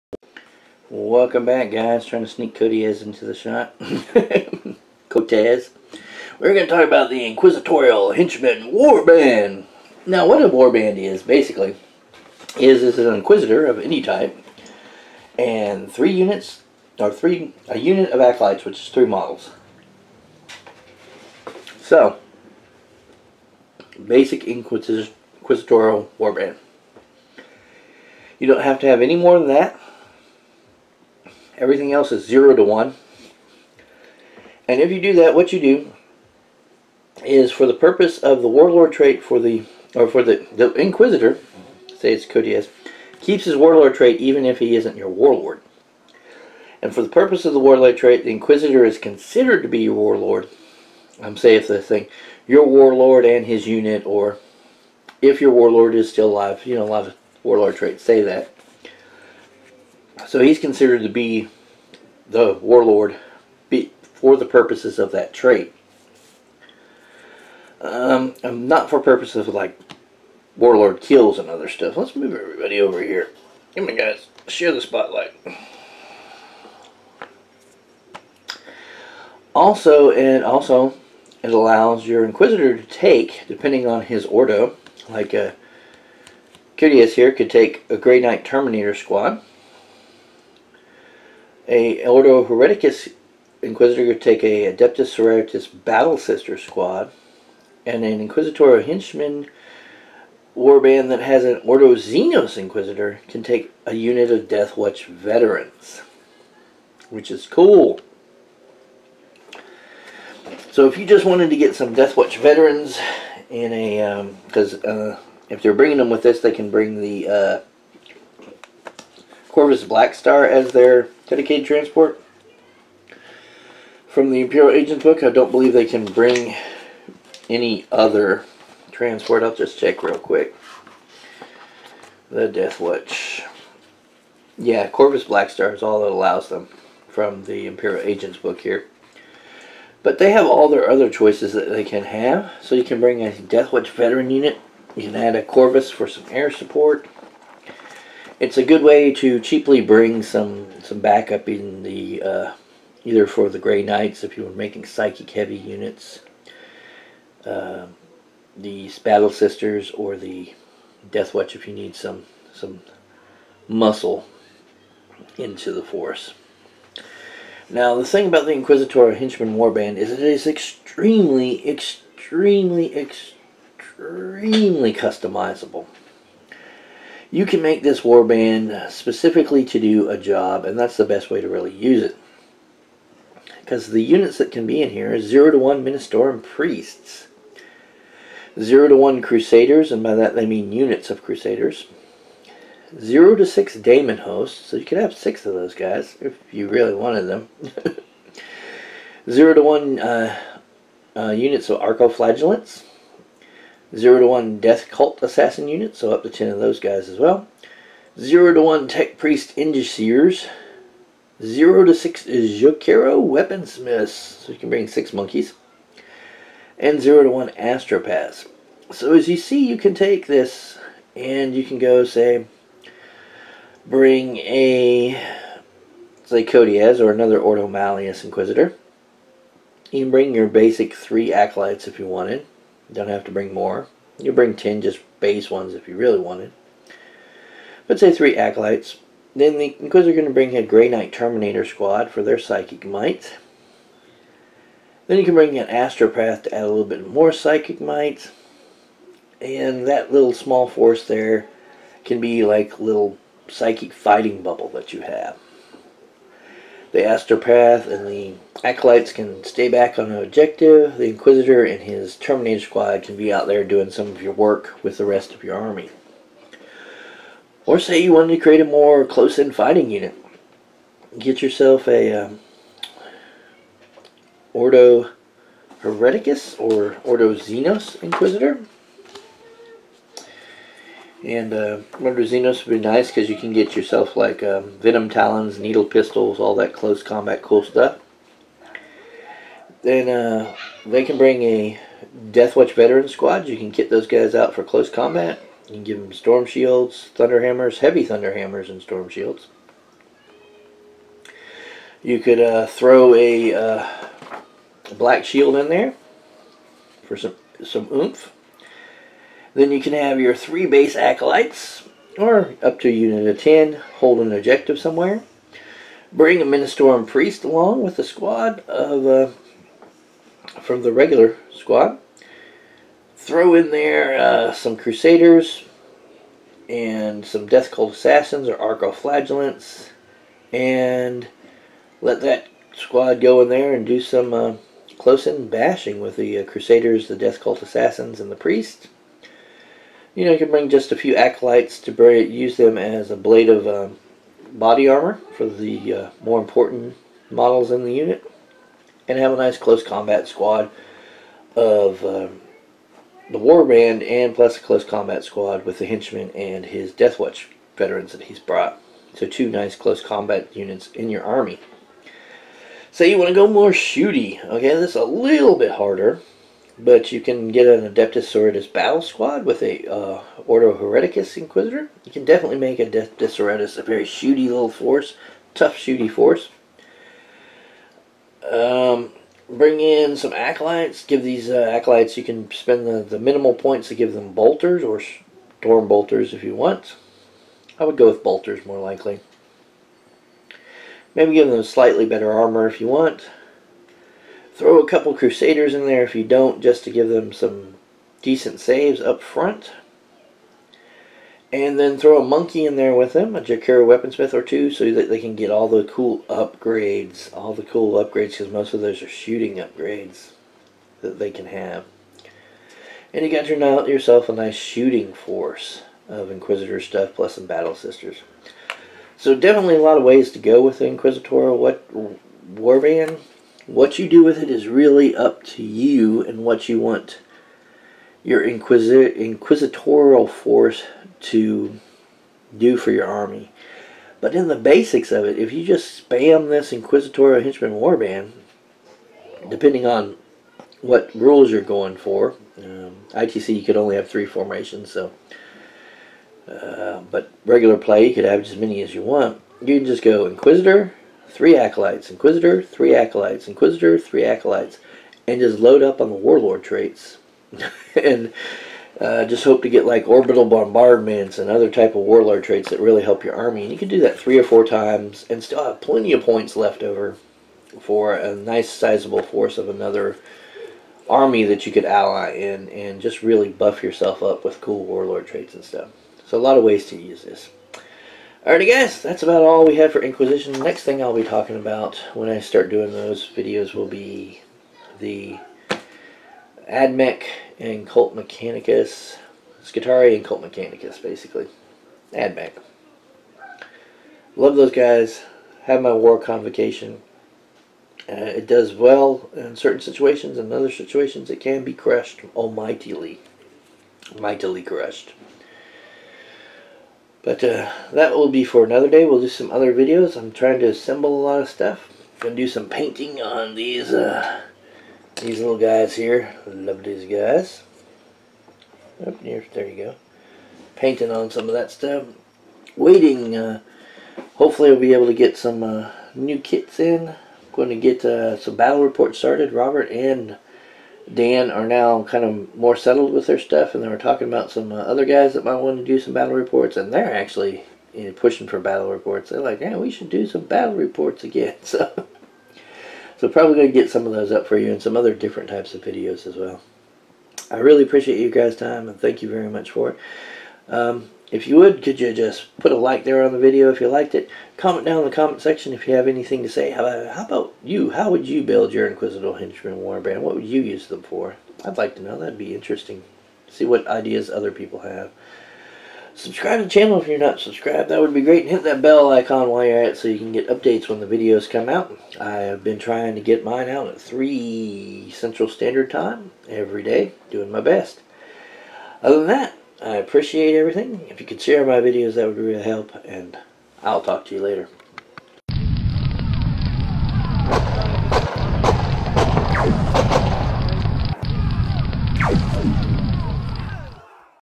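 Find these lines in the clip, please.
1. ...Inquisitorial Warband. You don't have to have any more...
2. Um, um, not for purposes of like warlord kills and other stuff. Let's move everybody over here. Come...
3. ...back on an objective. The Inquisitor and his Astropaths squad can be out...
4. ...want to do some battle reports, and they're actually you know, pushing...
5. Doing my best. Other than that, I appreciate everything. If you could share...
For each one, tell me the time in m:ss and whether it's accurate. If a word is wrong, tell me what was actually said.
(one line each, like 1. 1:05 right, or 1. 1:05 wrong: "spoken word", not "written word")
1. 0:24 right
2. 1:07 right
3. 4:19 wrong: "Terminator", not "Astropaths"
4. 8:55 right
5. 9:37 right.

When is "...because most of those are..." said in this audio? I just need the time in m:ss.
6:48.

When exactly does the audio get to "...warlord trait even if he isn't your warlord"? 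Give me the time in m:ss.
0:43.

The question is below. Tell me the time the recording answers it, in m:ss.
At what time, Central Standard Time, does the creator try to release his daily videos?
9:34.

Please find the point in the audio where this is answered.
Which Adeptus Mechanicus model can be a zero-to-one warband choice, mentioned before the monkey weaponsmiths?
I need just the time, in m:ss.
3:28.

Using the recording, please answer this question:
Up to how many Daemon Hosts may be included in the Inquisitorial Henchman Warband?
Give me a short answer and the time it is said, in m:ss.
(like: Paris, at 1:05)
6, at 3:12.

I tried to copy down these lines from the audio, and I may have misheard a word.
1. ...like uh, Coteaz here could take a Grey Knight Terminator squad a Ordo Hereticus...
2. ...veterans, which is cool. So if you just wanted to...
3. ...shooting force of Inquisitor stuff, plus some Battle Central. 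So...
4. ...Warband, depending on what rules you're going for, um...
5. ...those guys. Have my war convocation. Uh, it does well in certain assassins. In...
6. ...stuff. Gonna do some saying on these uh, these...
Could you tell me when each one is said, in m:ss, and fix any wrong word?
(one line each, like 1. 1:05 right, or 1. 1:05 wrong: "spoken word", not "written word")
1. 1:25 right
2. 1:45 right
3. 6:54 wrong: "Sisters", not "Central"
4. 7:17 right
5. 8:14 wrong: "situations", not "assassins"
6. 8:31 wrong: "painting", not "saying".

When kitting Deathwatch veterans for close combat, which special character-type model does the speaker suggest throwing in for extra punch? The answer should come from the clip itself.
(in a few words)
Black Shield.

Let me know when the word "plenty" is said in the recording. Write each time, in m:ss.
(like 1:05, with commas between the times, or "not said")
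7:45.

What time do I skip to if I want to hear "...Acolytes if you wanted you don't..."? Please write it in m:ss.
3:51.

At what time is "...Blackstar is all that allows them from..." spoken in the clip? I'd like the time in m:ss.
2:15.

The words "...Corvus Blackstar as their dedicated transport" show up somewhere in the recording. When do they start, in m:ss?
1:59.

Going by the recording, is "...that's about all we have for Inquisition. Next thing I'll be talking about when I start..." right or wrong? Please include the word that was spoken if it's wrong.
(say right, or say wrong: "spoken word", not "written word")
right.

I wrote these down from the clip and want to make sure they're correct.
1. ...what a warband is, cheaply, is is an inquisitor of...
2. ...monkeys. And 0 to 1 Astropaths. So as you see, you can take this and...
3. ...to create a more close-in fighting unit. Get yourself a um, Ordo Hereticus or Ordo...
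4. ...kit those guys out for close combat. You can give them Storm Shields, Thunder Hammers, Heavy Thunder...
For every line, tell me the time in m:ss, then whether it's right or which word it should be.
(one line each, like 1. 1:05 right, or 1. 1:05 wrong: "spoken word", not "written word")
1. 0:10 wrong: "basically", not "cheaply"
2. 3:35 right
3. 4:28 right
4. 4:53 right.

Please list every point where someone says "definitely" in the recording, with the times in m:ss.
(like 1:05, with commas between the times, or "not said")
6:12, 6:59.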